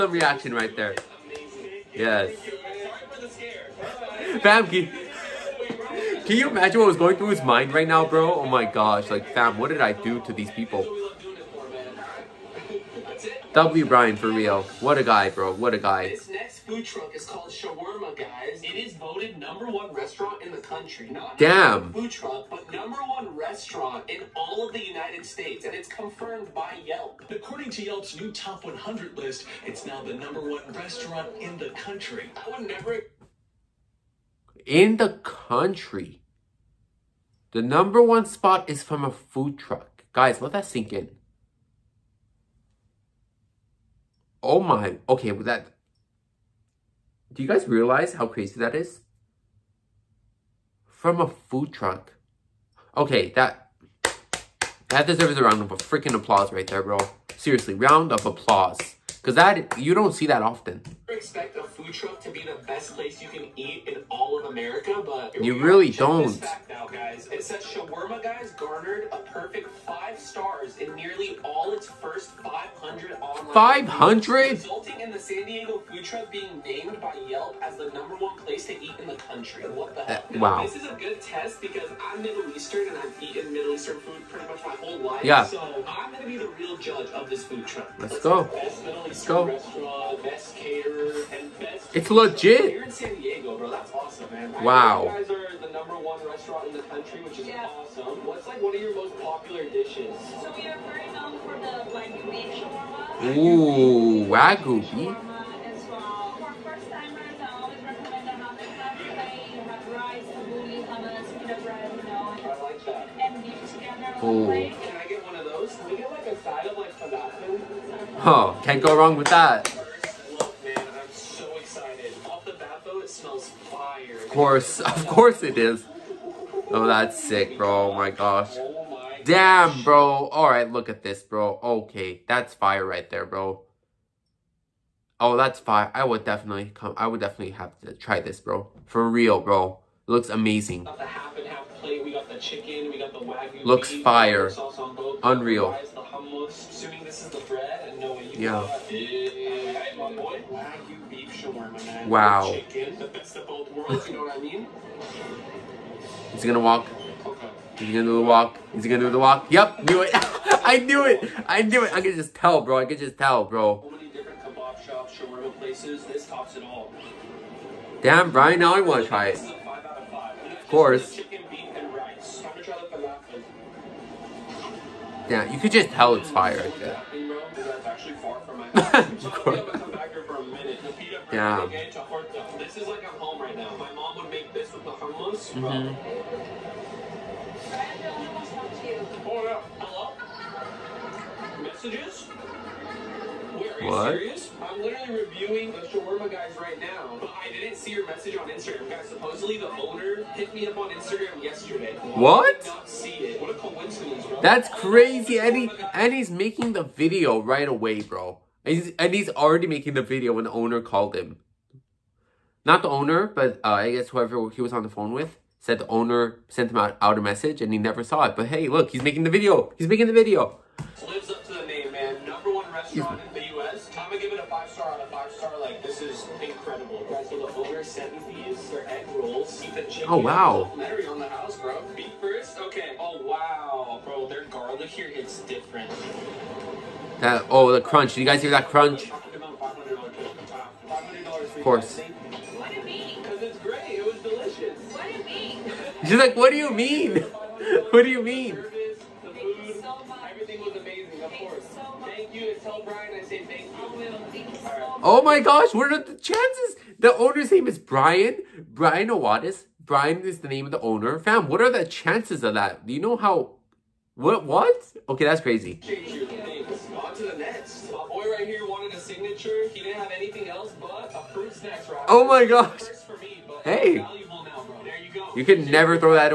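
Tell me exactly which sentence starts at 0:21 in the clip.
food truck, but number one restaurant in all of the United States, and it's confirmed by Yelp.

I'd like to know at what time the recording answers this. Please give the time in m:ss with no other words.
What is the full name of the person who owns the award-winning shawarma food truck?
4:18.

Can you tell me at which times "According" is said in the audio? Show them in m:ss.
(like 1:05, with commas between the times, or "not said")
0:27.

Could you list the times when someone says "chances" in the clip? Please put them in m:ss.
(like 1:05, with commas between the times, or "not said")
4:16, 4:21.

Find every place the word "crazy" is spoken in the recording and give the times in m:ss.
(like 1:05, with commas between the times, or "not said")
0:48, 3:24, 4:25.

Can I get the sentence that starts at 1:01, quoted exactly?
expect a food truck to be the best place you can eat in all of America, but...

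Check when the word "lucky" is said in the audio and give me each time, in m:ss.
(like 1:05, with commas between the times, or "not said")
not said.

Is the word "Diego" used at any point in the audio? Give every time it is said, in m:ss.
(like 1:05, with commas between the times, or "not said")
1:15.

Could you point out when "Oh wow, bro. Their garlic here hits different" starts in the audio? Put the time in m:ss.
3:52.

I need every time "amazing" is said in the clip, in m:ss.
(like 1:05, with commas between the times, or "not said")
2:20.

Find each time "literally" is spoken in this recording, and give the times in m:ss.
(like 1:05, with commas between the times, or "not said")
3:14.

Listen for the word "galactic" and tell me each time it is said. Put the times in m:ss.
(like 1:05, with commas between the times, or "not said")
not said.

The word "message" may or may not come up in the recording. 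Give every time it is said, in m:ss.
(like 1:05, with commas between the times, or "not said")
3:18, 3:37.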